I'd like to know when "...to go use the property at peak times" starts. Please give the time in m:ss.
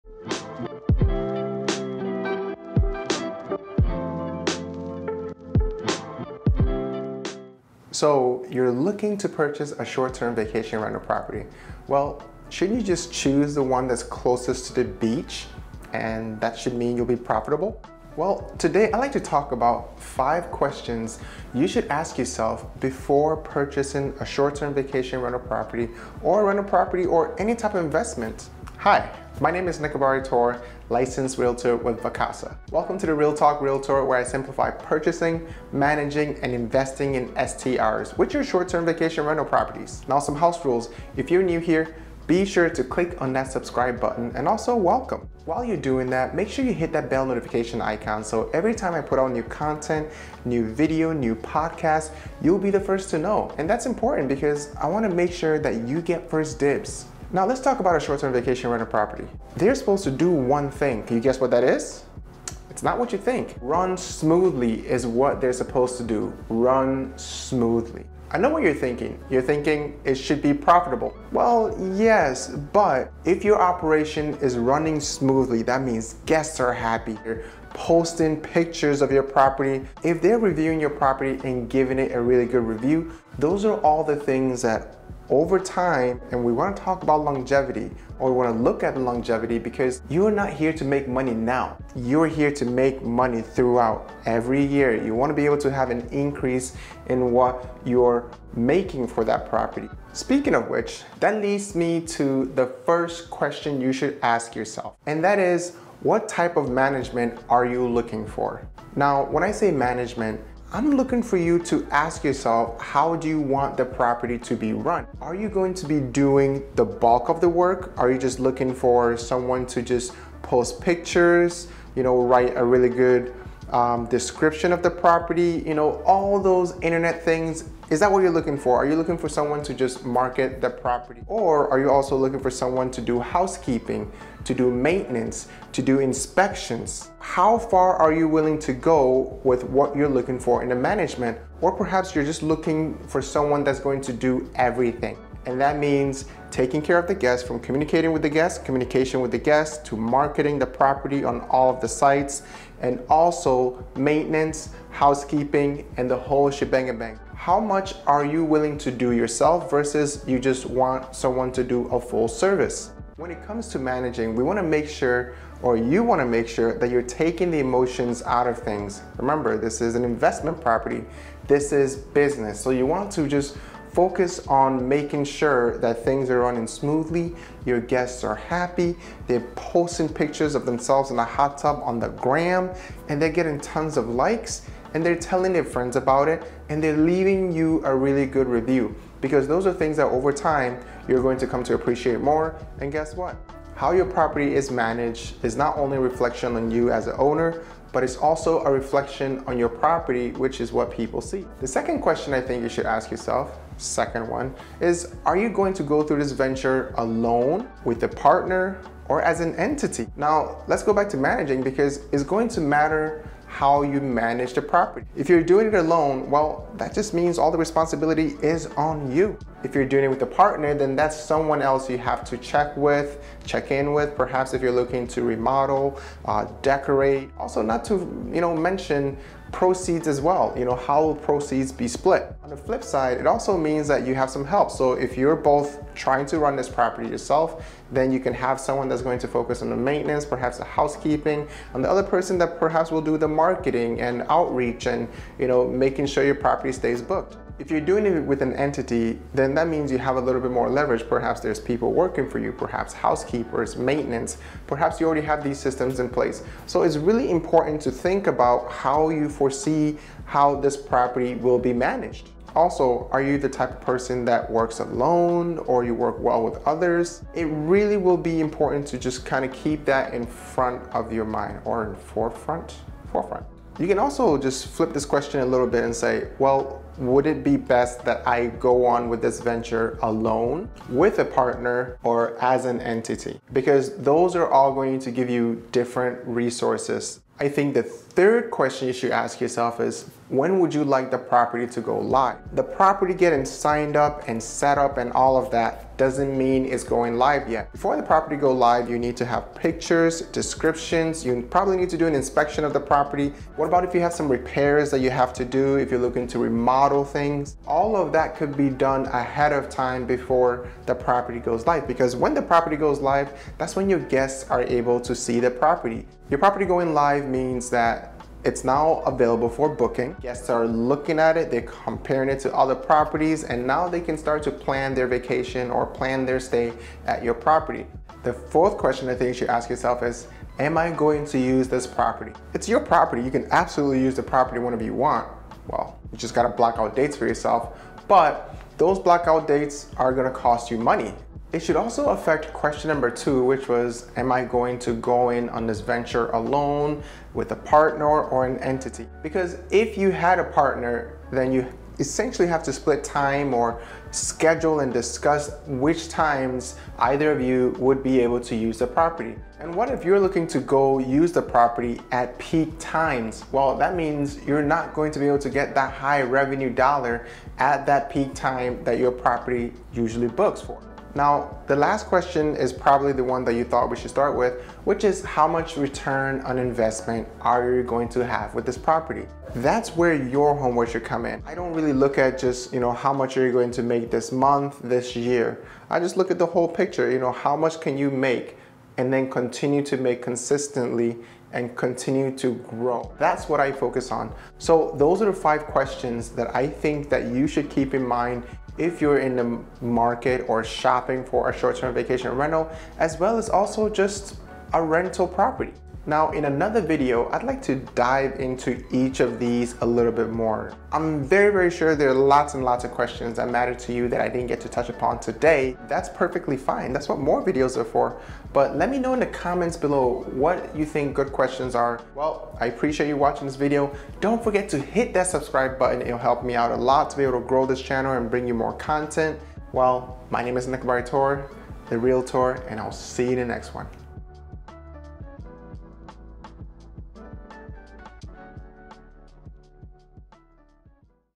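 6:00.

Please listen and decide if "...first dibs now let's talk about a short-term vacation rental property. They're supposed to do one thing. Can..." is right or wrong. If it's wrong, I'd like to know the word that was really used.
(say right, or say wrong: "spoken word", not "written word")
right.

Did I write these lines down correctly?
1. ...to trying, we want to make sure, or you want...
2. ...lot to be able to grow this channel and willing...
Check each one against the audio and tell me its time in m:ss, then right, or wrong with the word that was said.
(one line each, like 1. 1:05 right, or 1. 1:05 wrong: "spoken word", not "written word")
1. 2:43 wrong: "managing", not "trying"
2. 7:06 wrong: "bring", not "willing".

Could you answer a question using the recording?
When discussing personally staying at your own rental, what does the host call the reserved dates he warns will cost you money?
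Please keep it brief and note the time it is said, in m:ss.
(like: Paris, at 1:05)
Blackout dates, at 5:38.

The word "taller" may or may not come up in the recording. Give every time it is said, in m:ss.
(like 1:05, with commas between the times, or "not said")
not said.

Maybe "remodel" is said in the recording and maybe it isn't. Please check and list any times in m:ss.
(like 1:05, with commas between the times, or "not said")
3:45, 5:06.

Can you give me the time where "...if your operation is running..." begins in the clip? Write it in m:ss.
1:13.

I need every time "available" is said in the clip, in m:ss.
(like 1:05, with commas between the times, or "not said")
5:19.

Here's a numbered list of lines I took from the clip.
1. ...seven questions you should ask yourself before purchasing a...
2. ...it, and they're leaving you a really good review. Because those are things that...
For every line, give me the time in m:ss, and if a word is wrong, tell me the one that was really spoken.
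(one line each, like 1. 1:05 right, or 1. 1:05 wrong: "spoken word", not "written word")
1. 0:19 wrong: "five", not "seven"
2. 3:06 right.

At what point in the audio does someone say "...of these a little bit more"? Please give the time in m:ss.
6:49.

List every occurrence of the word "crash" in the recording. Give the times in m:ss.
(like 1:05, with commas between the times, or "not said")
not said.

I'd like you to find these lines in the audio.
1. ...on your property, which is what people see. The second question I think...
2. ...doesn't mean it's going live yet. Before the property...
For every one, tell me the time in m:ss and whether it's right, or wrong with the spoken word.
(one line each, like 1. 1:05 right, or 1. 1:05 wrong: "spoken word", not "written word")
1. 3:19 right
2. 4:55 right.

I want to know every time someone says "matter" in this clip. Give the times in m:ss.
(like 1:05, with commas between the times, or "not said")
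3:32, 6:53.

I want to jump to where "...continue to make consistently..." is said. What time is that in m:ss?
6:29.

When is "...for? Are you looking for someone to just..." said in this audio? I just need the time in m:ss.
2:08.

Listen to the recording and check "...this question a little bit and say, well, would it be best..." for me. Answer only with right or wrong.
right.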